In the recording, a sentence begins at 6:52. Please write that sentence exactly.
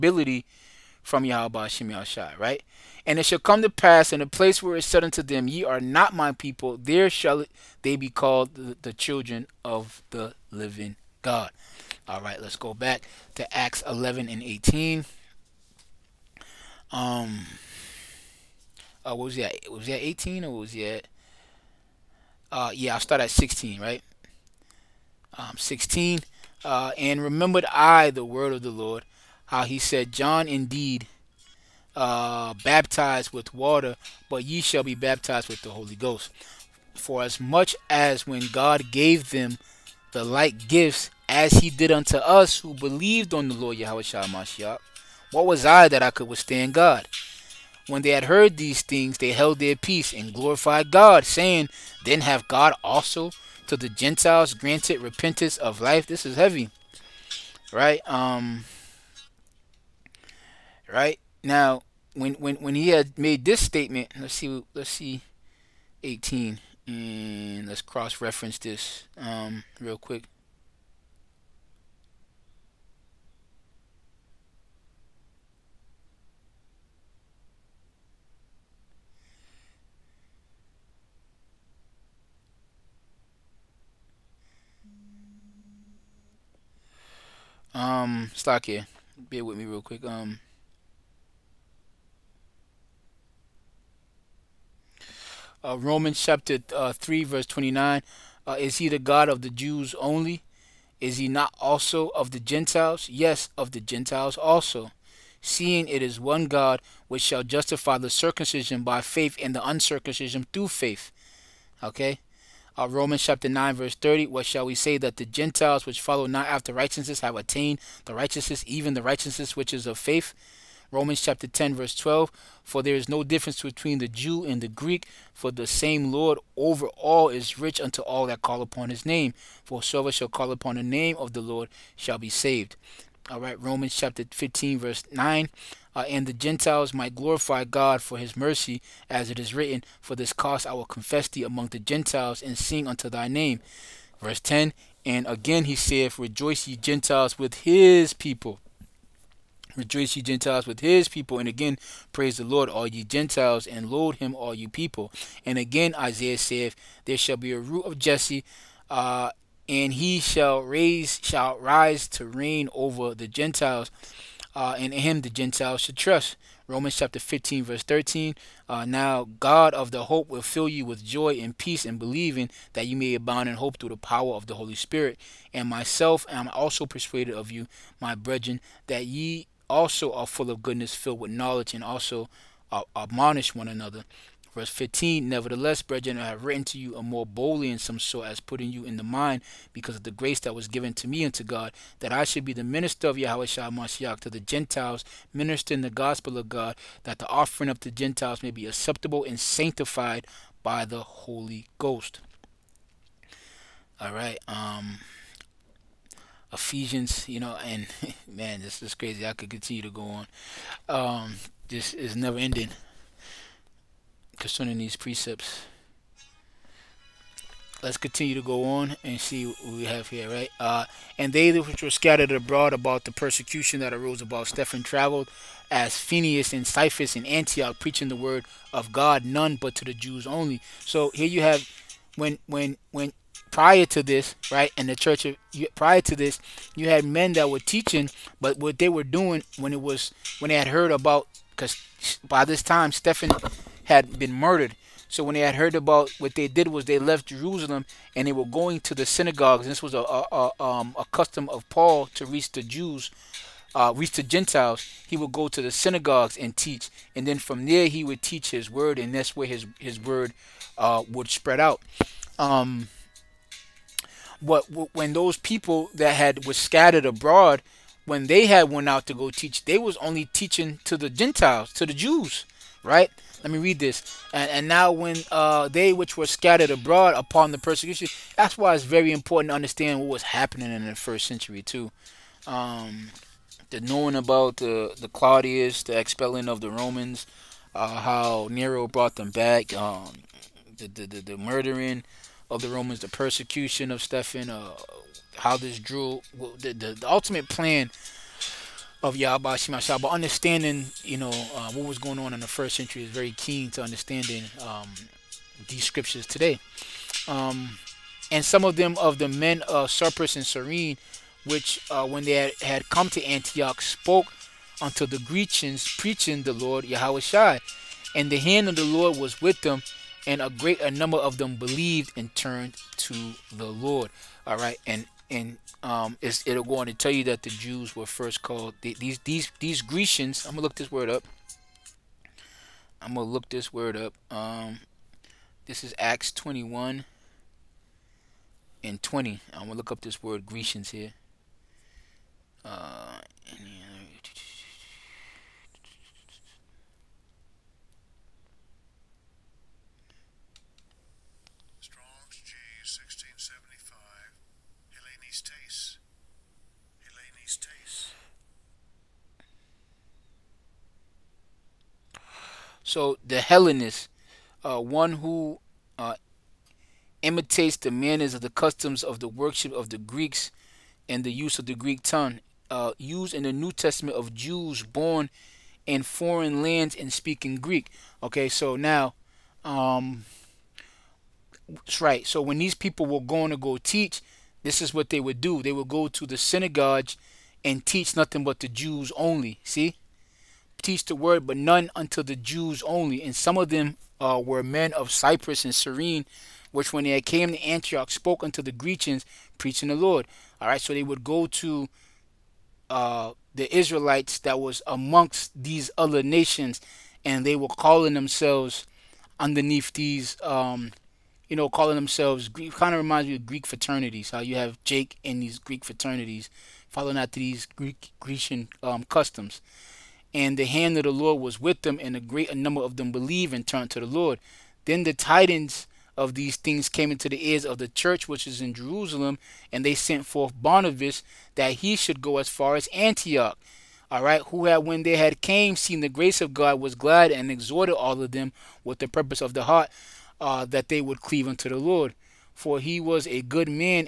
Kind of reminds me of Greek fraternities.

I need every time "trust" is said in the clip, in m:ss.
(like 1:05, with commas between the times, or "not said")
2:45.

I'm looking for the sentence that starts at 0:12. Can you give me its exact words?
All right, let's go back to Acts 11 and 18.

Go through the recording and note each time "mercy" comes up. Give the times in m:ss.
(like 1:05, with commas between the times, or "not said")
2:18.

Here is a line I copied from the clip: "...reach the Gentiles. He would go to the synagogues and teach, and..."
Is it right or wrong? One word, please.
right.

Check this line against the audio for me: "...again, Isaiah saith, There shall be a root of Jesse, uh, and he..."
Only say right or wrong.
right.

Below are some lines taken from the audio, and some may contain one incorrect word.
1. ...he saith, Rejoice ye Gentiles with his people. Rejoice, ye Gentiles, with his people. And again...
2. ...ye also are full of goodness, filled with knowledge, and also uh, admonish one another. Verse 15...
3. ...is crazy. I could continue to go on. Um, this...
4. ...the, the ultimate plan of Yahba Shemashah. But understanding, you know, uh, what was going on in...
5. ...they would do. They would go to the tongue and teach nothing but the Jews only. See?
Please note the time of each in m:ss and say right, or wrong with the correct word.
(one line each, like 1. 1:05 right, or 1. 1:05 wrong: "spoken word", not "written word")
1. 2:25 right
2. 2:59 right
3. 3:28 right
4. 4:56 right
5. 6:25 wrong: "synagogue", not "tongue".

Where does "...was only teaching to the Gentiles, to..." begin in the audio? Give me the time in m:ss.
4:29.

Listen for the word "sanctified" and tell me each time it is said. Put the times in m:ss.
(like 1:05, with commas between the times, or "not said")
3:19.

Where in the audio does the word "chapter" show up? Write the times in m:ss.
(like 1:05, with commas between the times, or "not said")
1:36, 1:53, 2:01, 2:13, 2:46.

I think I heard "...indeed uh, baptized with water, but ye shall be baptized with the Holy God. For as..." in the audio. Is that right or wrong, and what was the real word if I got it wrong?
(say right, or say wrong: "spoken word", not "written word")
wrong: "Ghost", not "God".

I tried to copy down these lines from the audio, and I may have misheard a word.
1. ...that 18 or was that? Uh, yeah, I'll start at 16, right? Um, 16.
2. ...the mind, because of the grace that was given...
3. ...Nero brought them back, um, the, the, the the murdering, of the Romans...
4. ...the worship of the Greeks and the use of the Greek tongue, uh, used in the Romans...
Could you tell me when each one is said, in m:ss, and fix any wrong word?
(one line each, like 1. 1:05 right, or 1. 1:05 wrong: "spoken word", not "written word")
1. 0:19 right
2. 3:08 right
3. 4:48 right
4. 6:09 wrong: "New", not "Romans".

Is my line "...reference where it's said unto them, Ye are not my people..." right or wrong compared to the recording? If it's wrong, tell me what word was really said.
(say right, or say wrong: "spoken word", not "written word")
wrong: "place", not "reference".